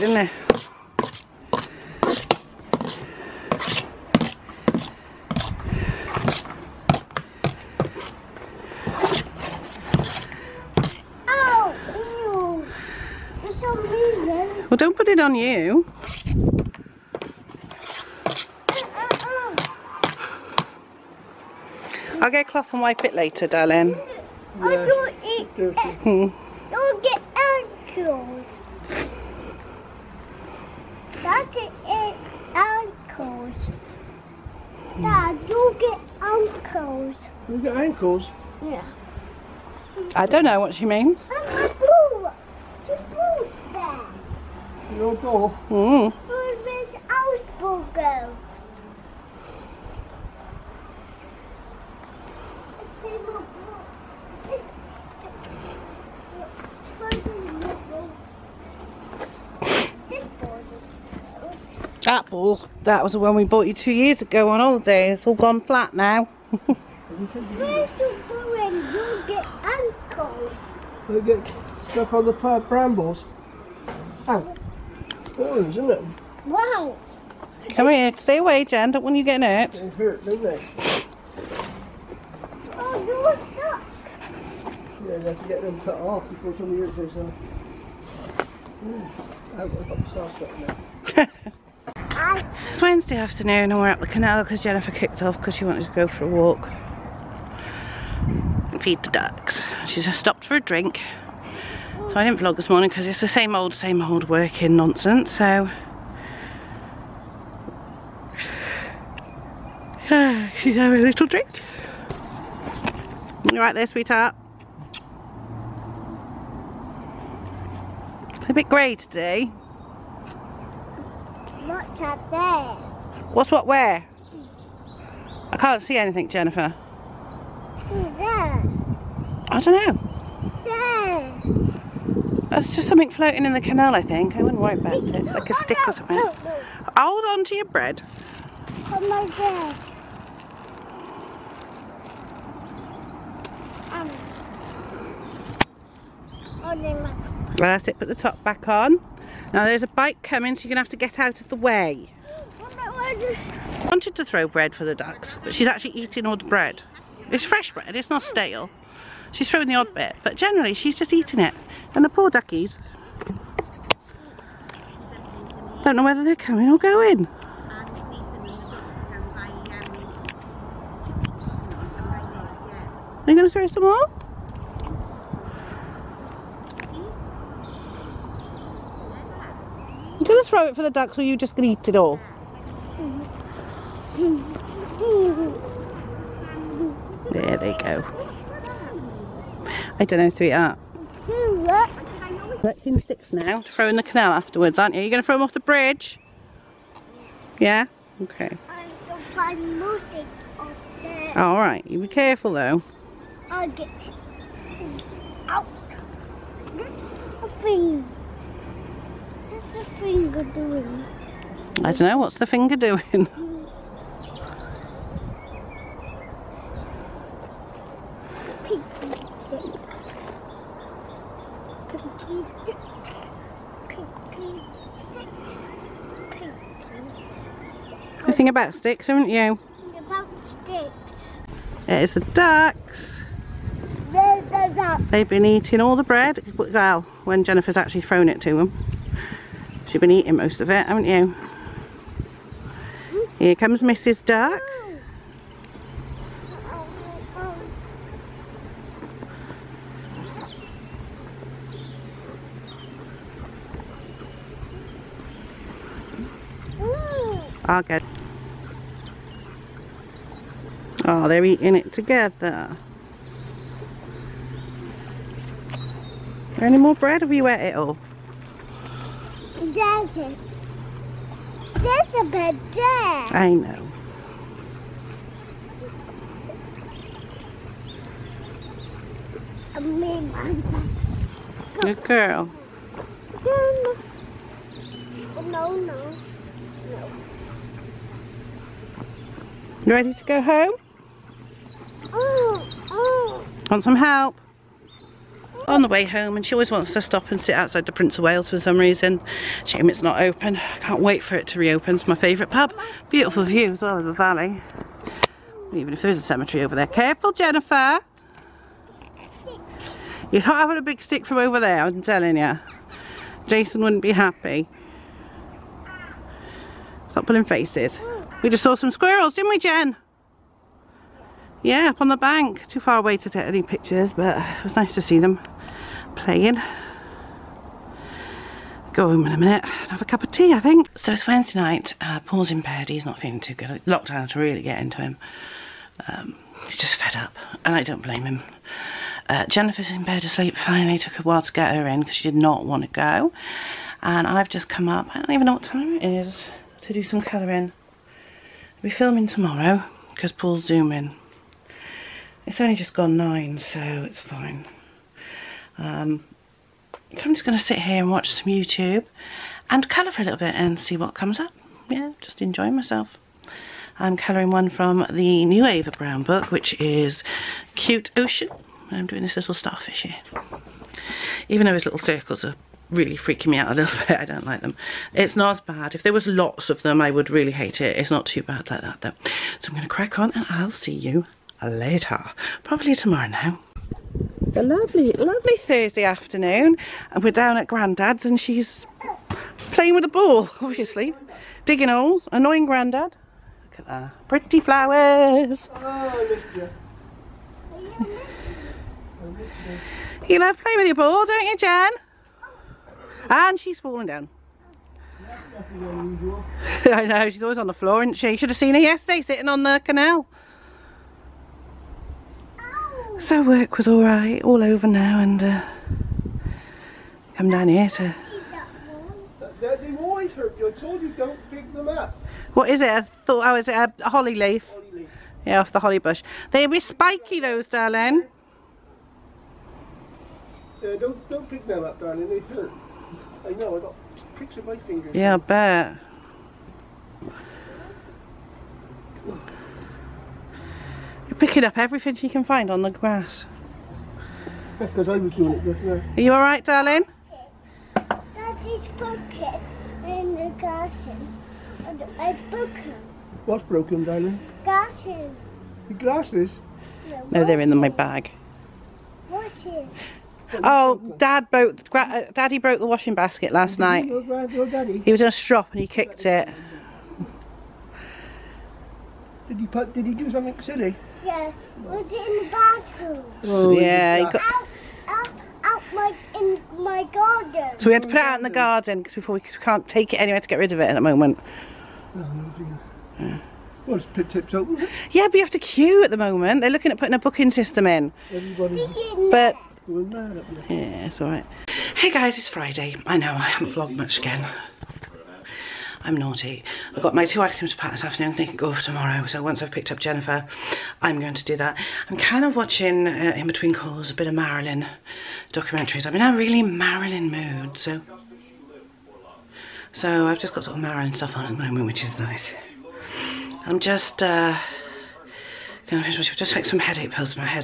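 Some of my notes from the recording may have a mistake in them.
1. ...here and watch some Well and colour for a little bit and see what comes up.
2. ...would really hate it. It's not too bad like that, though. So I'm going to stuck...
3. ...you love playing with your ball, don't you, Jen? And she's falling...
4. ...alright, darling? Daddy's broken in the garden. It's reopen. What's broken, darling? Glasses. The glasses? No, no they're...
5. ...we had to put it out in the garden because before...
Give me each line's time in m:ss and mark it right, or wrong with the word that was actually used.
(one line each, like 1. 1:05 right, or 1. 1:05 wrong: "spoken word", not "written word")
1. 5:57 wrong: "YouTube", not "Well"
2. 6:17 wrong: "crack", not "stuck"
3. 6:40 right
4. 7:26 wrong: "broken", not "reopen"
5. 7:57 right.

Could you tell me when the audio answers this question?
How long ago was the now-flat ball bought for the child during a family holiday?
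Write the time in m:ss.
1:03.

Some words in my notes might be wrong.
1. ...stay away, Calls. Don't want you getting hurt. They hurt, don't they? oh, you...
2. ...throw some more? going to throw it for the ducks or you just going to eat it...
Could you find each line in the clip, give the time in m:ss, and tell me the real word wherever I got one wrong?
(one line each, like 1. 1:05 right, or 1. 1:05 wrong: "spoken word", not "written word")
1. 1:18 wrong: "Jen", not "Calls"
2. 2:53 right.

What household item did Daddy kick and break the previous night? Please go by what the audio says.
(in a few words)
Washing basket.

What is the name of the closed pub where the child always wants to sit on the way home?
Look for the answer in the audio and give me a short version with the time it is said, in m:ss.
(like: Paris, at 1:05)
Prince of Wales, at 4:57.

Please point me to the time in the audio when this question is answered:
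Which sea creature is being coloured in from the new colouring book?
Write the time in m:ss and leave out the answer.
6:09.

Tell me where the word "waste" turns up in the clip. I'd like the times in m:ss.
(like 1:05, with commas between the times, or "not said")
not said.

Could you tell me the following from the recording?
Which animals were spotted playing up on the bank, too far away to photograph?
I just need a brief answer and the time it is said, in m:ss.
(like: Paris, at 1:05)
Squirrels, at 5:18.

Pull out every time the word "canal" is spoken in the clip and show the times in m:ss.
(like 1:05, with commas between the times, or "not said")
1:34, 2:13, 3:14, 6:49.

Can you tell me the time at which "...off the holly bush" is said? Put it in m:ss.
7:05.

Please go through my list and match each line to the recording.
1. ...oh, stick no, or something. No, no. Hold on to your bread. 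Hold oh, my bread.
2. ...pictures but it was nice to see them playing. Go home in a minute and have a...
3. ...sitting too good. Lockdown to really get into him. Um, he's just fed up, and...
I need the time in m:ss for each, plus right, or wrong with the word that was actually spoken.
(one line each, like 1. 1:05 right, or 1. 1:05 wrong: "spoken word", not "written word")
1. 2:15 right
2. 5:23 right
3. 5:33 wrong: "feeling", not "sitting".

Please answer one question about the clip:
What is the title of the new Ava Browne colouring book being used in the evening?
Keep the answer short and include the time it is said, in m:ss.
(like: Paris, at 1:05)
Cute Ocean, at 6:07.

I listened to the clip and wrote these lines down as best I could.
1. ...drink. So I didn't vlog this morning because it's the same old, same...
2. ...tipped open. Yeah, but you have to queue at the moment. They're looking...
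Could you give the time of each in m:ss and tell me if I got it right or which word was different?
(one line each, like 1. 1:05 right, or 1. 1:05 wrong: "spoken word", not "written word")
1. 1:40 right
2. 8:04 right.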